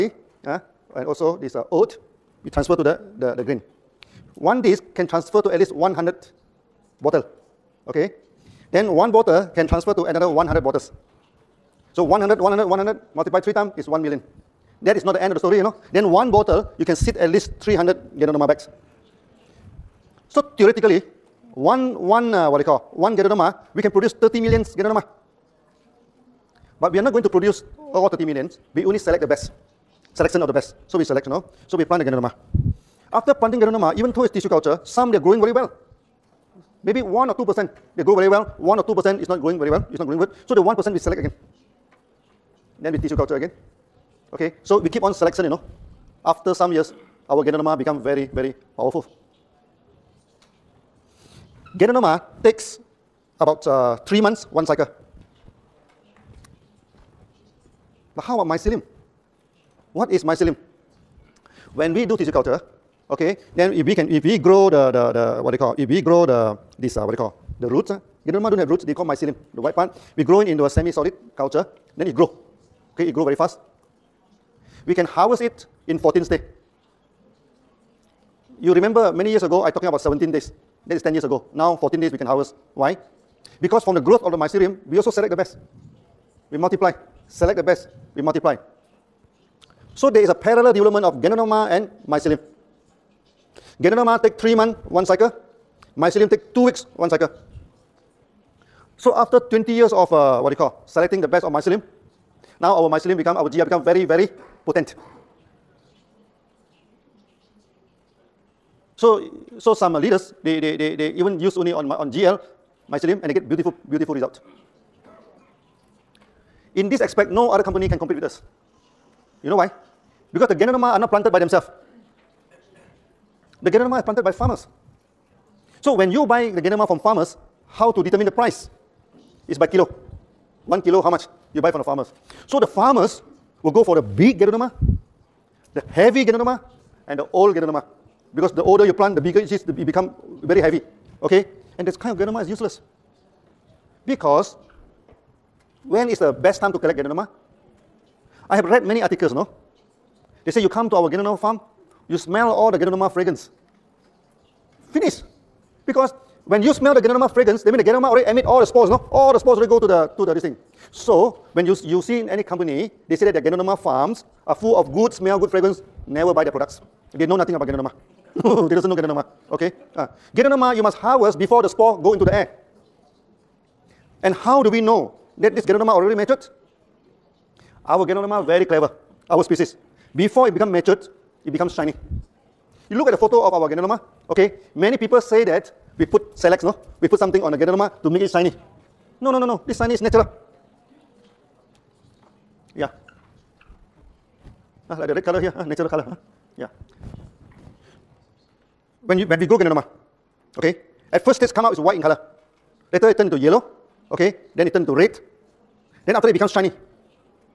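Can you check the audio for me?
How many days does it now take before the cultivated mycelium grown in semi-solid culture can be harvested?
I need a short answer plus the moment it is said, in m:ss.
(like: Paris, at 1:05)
14 days, at 1:21.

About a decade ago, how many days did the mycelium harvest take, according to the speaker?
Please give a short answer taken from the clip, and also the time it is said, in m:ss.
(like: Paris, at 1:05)
17 days, at 1:19.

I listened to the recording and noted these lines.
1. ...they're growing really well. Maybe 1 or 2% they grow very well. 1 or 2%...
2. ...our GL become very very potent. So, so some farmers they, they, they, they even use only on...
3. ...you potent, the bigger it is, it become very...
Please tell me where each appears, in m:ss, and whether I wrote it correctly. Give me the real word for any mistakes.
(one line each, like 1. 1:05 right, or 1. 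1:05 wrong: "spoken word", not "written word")
1. 0:35 right
2. 1:43 wrong: "leaders", not "farmers"
3. 2:18 wrong: "plant", not "potent".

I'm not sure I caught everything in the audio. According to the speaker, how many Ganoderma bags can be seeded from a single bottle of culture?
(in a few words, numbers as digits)
300.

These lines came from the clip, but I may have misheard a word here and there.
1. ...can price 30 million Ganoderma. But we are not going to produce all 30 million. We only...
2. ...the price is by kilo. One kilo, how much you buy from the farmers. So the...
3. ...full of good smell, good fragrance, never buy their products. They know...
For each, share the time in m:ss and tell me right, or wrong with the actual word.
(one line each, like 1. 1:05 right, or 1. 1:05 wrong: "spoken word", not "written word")
1. 0:23 wrong: "produce", not "price"
2. 2:08 right
3. 2:44 right.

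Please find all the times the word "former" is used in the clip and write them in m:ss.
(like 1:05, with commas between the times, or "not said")
not said.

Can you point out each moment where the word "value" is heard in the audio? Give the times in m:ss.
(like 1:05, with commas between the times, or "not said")
not said.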